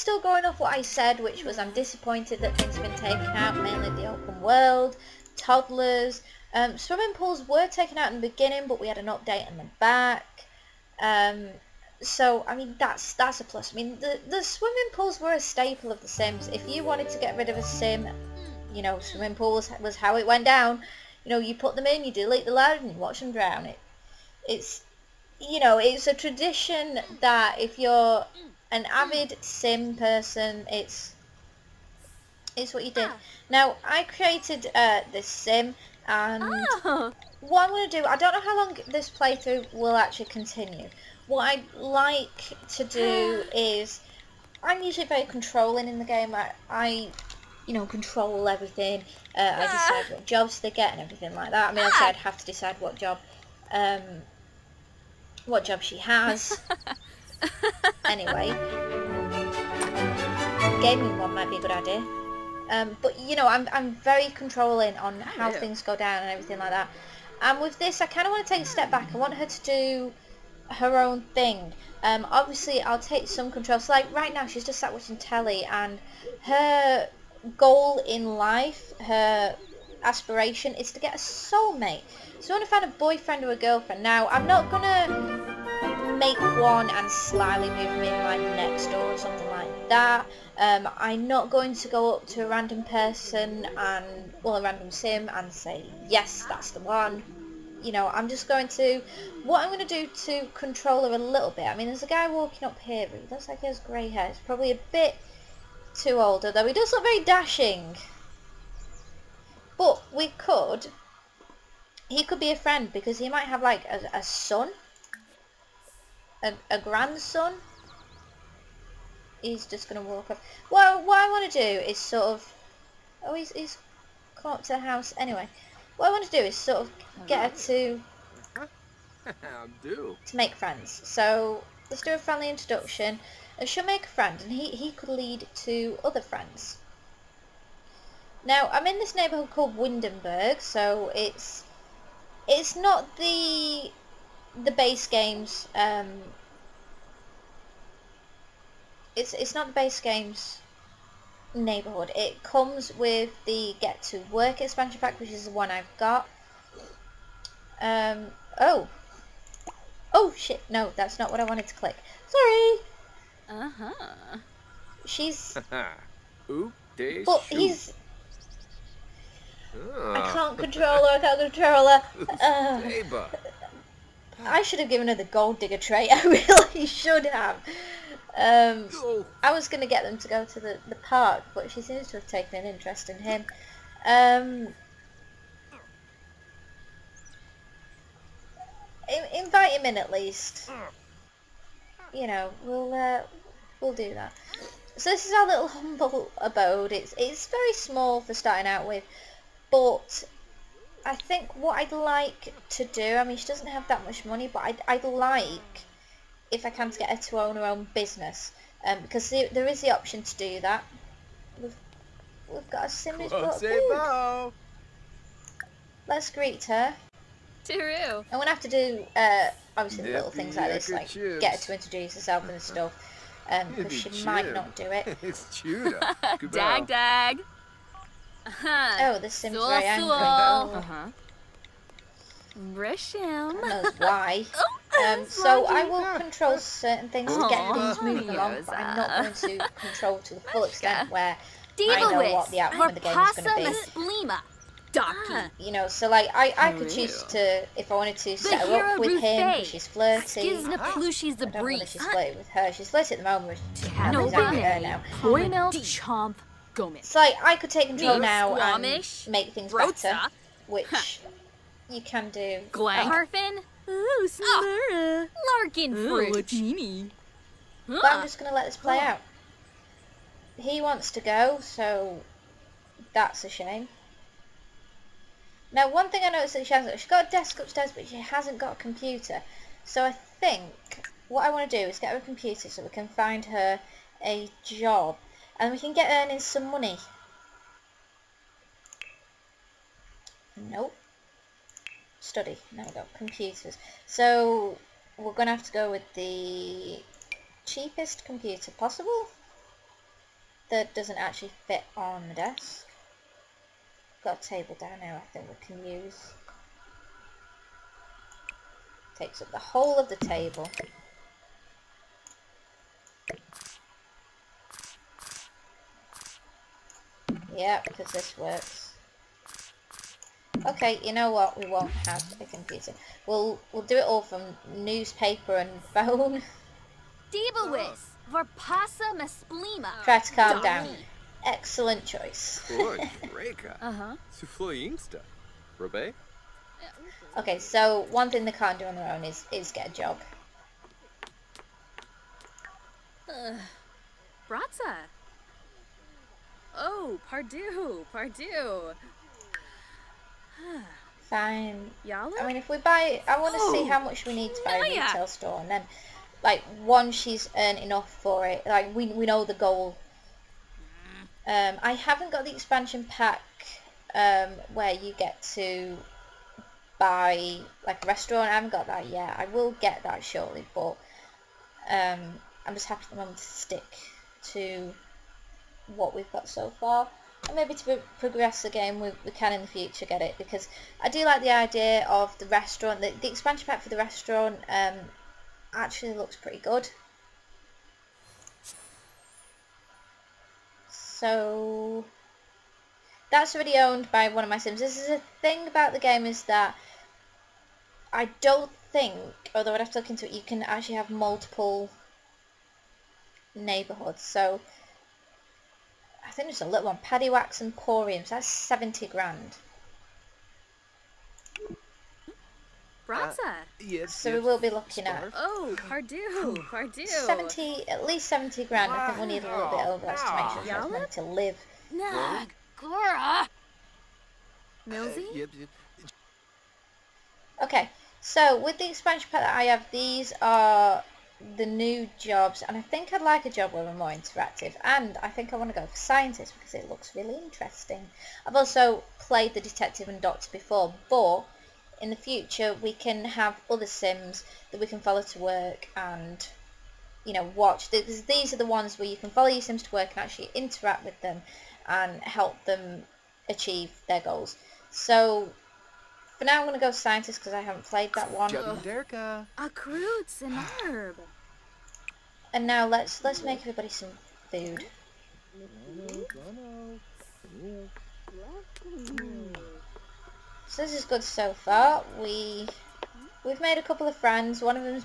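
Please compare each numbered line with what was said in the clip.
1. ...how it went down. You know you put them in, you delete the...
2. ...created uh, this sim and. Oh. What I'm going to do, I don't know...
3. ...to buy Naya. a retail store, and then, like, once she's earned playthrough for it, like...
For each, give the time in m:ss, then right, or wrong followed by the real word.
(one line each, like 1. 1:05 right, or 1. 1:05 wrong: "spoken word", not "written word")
1. 0:19 right
2. 0:34 right
3. 5:54 wrong: "enough", not "playthrough".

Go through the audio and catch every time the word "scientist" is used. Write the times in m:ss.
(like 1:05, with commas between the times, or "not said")
7:15, 7:36.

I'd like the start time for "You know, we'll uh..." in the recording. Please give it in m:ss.
3:12.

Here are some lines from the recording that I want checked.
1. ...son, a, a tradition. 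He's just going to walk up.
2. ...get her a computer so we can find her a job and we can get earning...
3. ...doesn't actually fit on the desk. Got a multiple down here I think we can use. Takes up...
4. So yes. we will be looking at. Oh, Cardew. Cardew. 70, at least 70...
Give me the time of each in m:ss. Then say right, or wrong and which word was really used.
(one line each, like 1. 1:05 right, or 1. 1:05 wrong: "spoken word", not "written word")
1. 1:54 wrong: "grandson", not "tradition"
2. 4:41 right
3. 5:00 wrong: "table", not "multiple"
4. 6:54 right.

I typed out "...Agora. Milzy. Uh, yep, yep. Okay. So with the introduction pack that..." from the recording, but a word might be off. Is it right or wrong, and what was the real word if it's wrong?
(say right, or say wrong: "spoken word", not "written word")
wrong: "expansion", not "introduction".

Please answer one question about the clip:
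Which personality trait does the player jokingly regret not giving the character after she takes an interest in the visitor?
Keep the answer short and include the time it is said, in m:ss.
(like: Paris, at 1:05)
Gold digger, at 2:55.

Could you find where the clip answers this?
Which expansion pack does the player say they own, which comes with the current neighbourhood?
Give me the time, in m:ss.
2:33.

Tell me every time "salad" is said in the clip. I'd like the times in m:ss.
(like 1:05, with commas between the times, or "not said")
not said.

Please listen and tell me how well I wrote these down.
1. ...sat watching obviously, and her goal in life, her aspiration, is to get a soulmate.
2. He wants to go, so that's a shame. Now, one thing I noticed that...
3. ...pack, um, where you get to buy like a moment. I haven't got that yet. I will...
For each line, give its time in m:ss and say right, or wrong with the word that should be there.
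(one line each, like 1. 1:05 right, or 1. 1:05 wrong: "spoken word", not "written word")
1. 1:14 wrong: "telly", not "obviously"
2. 4:30 right
3. 6:03 wrong: "restaurant", not "moment".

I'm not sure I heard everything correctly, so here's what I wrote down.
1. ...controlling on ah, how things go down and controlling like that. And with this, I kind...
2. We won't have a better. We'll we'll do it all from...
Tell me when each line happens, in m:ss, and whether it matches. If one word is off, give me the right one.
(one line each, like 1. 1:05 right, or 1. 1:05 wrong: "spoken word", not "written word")
1. 1:04 wrong: "everything", not "controlling"
2. 5:21 wrong: "computer", not "better".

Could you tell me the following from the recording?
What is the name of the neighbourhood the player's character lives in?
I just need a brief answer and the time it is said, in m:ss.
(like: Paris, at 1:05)
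Windenburg, at 2:19.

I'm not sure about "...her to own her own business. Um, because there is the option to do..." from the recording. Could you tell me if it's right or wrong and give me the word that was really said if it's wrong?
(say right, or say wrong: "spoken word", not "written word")
right.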